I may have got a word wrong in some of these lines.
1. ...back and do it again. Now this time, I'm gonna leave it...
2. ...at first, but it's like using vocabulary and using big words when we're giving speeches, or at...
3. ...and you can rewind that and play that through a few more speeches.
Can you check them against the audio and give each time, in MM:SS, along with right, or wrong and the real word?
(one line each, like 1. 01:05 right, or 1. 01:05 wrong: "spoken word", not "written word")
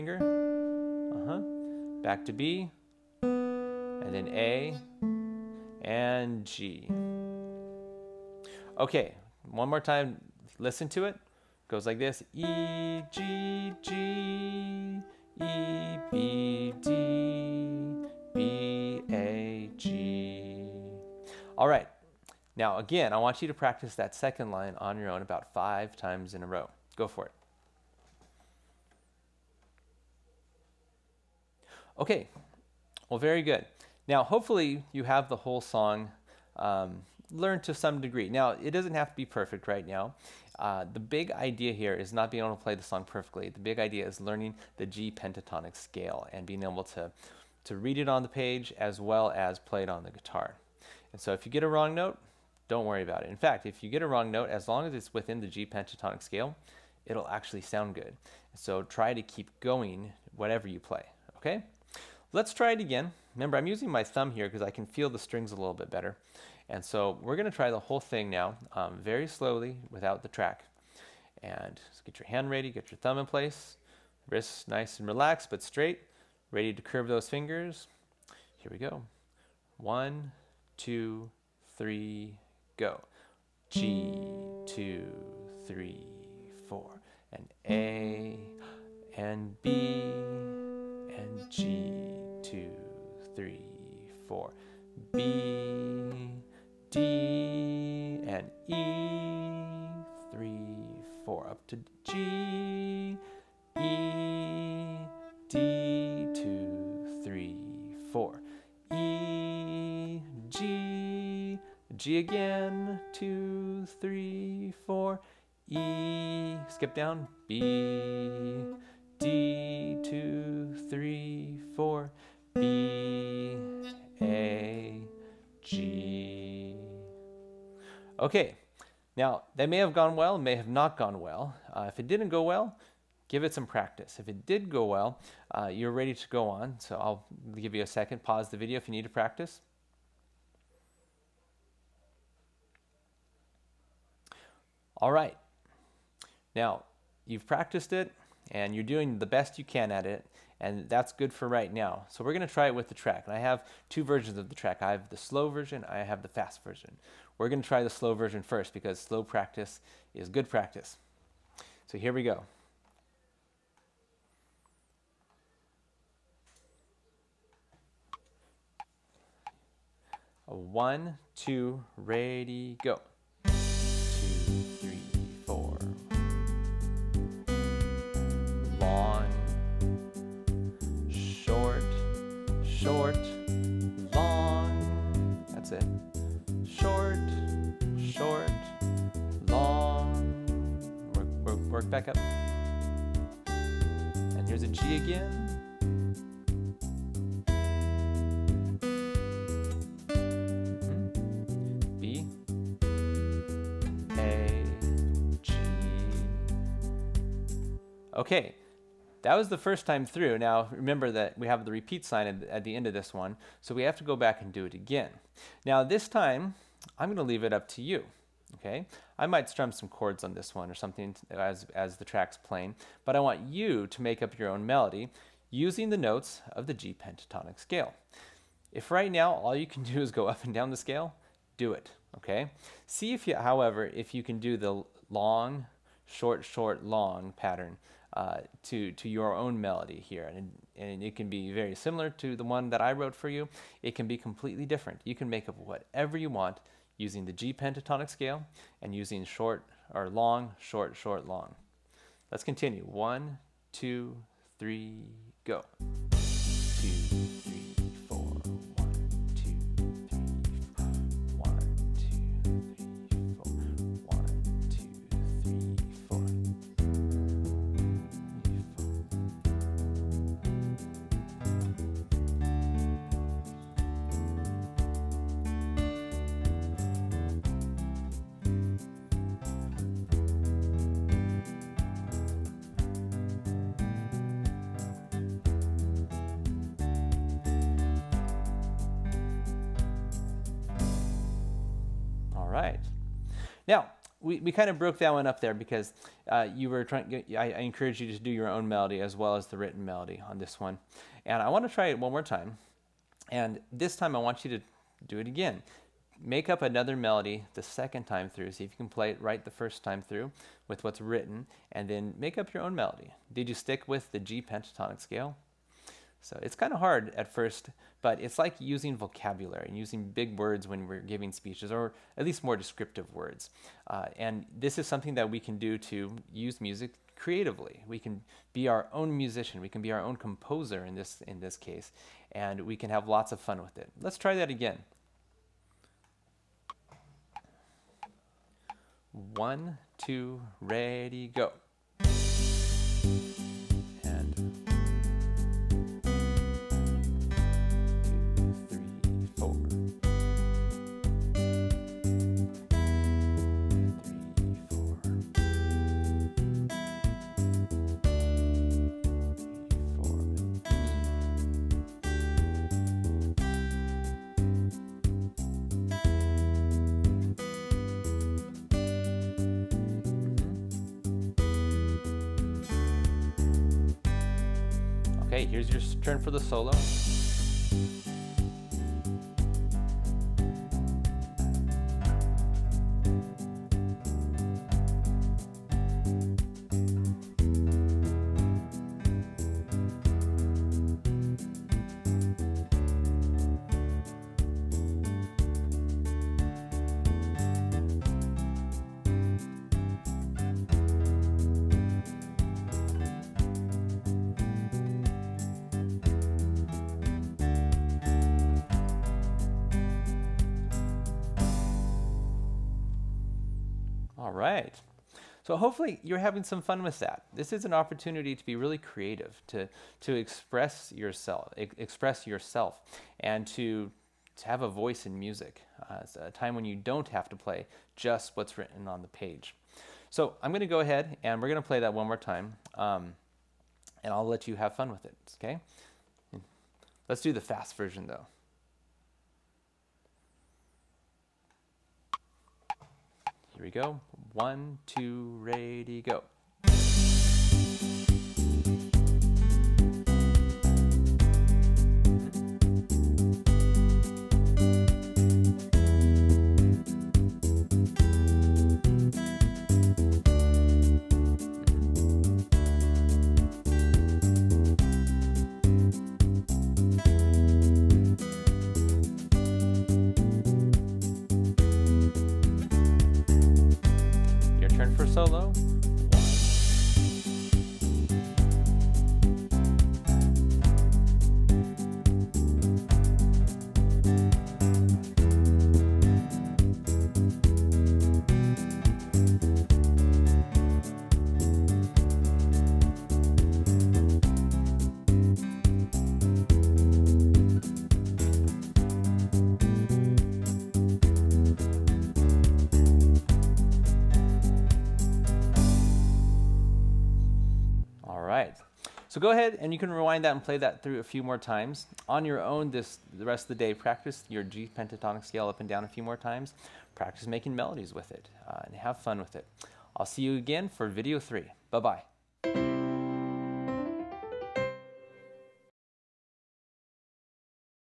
1. 03:34 right
2. 05:17 right
3. 08:29 wrong: "times", not "speeches".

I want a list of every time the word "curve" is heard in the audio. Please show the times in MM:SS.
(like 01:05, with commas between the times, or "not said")
01:16.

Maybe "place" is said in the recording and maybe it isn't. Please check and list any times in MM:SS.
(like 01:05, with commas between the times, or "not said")
01:13.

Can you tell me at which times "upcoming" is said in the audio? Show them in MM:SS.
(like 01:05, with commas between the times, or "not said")
not said.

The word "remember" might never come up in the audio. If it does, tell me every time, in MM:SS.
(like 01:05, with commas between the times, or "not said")
01:03, 03:30.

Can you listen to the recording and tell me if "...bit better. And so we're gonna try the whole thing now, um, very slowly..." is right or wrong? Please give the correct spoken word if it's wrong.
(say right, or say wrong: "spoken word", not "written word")
right.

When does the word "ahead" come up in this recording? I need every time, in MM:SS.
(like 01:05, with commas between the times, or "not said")
07:10, 08:29.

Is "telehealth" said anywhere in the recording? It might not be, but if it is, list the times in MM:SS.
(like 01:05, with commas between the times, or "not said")
not said.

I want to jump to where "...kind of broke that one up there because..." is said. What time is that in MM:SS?
04:54.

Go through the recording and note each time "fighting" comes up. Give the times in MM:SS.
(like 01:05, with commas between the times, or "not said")
not said.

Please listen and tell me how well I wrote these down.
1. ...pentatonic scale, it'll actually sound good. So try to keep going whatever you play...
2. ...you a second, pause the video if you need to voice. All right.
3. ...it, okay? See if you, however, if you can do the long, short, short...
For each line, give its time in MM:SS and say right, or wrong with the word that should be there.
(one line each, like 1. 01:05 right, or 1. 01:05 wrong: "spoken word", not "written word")
1. 00:55 right
2. 02:17 wrong: "practice", not "voice"
3. 03:51 right.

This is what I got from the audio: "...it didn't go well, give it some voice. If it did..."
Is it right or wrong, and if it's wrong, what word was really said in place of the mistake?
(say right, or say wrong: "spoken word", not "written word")
wrong: "practice", not "voice".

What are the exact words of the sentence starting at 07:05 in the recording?
Uh, it's a time when you don't have to play just what's written on the page.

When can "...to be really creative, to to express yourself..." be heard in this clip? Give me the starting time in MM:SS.
06:58.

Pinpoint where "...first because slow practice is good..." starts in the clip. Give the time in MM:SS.
02:38.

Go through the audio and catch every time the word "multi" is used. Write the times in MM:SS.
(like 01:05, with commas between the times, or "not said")
not said.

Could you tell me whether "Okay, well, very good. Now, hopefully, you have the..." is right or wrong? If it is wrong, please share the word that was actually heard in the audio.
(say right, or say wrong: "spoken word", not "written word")
right.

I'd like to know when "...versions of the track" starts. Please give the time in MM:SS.
02:34.